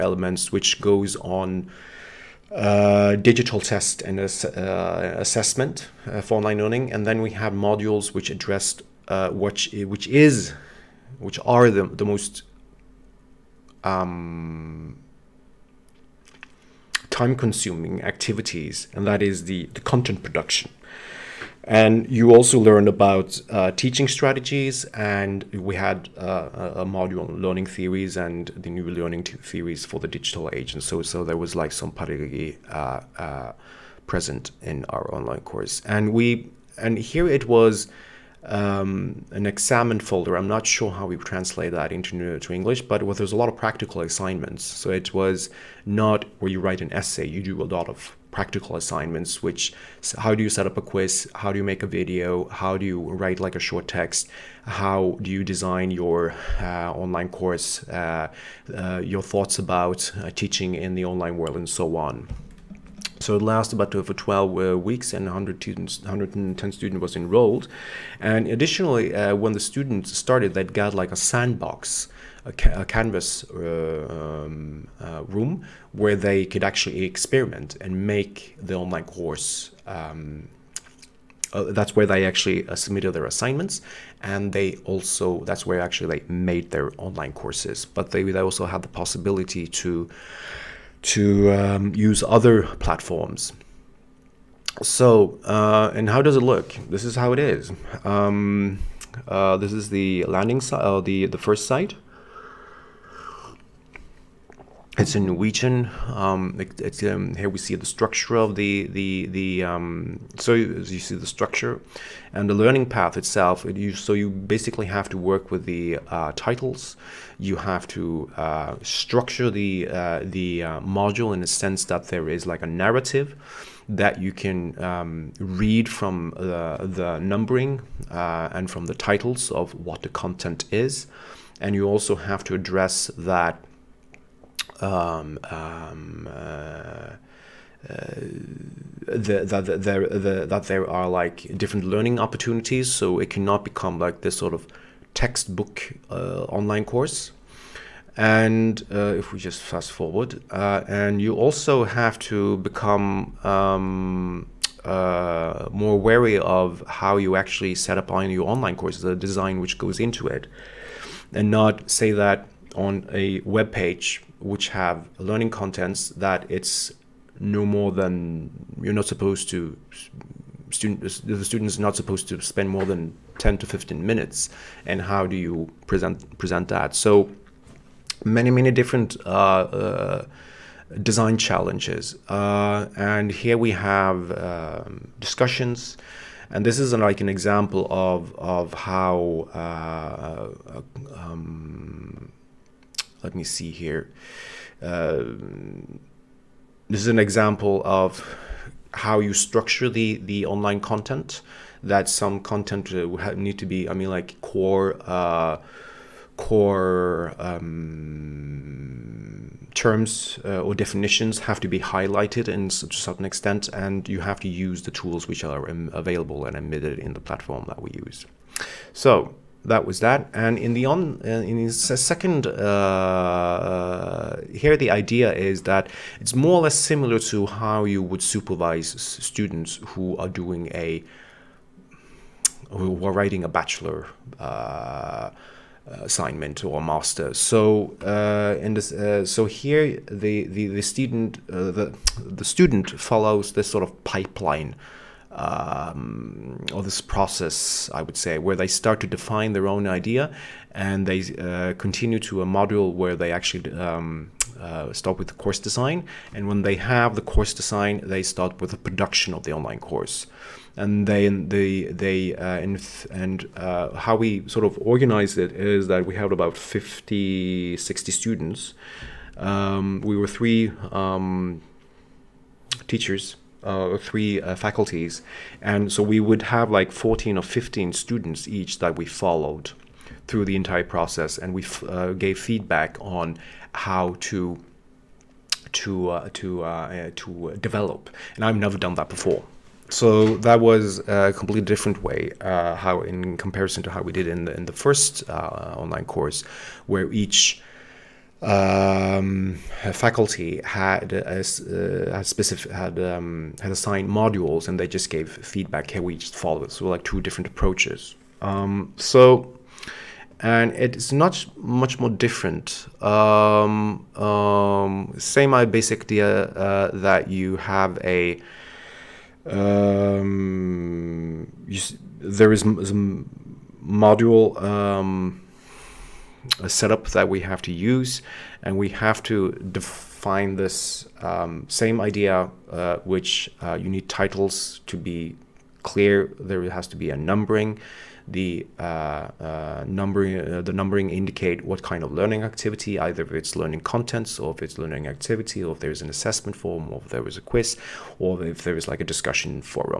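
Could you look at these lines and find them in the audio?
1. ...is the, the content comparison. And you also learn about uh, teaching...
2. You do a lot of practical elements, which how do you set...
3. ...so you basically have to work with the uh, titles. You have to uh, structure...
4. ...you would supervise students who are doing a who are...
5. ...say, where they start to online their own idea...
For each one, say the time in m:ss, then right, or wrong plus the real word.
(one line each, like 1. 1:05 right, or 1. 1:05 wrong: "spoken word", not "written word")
1. 0:19 wrong: "production", not "comparison"
2. 0:47 wrong: "assignments", not "elements"
3. 1:53 right
4. 3:47 right
5. 4:08 wrong: "define", not "online".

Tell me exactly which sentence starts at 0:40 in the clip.
I'm not sure how we translate that into to English, but there's a lot of practical assignments.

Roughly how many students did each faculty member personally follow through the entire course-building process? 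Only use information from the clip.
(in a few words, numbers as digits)
14 or 15.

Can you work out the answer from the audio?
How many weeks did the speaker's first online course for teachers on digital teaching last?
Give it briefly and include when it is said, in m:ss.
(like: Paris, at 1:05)
12 weeks, at 1:04.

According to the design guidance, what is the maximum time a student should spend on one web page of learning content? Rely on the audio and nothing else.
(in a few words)
10 to 15 minutes.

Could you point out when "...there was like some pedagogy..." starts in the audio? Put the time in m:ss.
0:31.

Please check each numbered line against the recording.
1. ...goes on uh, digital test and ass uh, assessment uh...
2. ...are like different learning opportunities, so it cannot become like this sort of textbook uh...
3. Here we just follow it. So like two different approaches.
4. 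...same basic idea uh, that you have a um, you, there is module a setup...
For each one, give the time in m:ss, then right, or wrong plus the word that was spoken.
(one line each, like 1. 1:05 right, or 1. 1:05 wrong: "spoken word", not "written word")
1. 0:00 right
2. 2:20 right
3. 5:05 right
4. 5:15 right.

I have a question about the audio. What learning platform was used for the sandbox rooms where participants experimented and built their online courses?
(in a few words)
Canvas.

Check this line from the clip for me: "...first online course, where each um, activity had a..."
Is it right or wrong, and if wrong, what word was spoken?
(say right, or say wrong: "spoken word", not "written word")
wrong: "faculty", not "activity".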